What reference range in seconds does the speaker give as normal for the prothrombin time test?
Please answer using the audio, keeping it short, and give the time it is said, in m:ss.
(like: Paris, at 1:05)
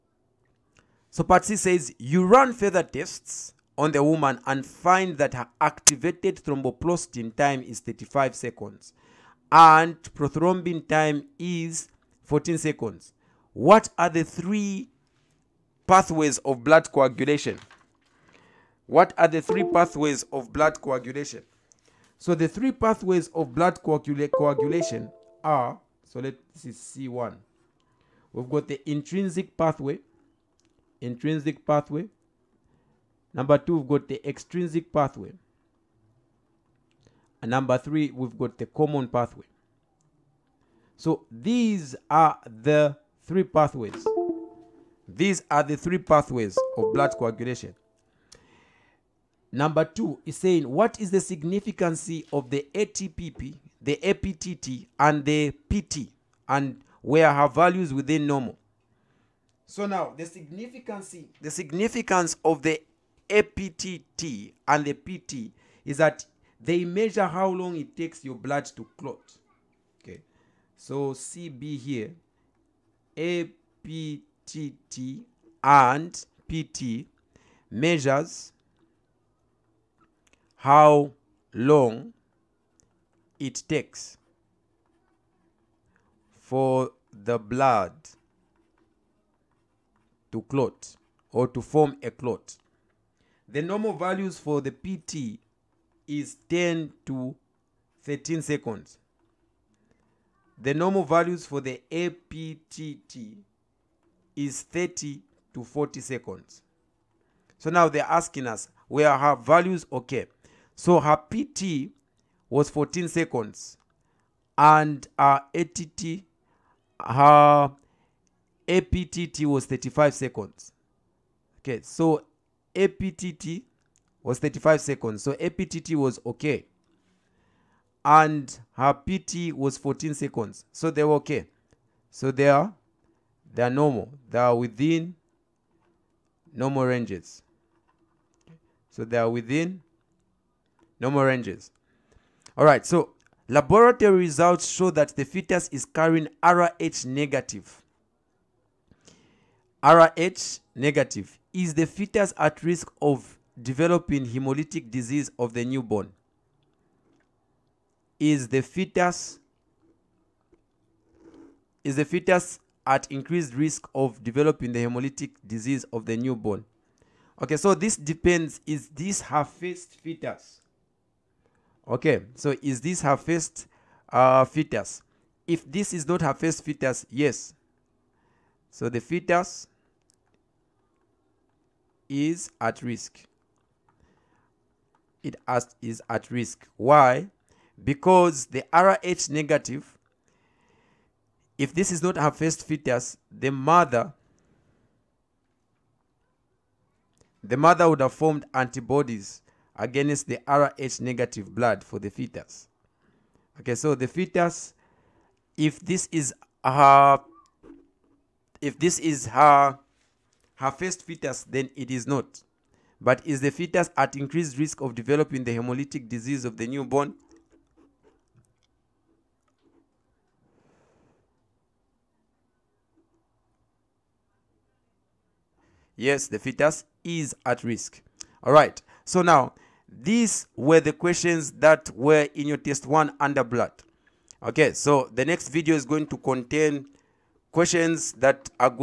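10 to 13 seconds, at 1:36.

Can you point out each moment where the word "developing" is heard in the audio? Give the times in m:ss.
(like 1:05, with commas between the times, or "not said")
2:33, 2:44, 3:34.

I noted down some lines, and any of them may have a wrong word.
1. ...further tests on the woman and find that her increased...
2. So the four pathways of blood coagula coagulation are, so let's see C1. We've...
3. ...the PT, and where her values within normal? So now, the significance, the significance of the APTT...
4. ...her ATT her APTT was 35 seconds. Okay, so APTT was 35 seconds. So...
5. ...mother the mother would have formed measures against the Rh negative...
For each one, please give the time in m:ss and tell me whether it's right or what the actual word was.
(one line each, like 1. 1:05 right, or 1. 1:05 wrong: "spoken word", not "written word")
1. 0:02 wrong: "activated", not "increased"
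2. 0:22 wrong: "three", not "four"
3. 0:55 right
4. 1:55 right
5. 3:13 wrong: "antibodies", not "measures".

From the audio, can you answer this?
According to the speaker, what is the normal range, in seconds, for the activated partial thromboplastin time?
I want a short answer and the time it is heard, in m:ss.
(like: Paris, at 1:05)
30 to 40 seconds, at 1:44.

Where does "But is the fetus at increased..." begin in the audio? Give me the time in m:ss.
3:32.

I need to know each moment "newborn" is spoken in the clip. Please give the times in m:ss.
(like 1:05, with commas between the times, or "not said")
2:35, 2:46, 3:36.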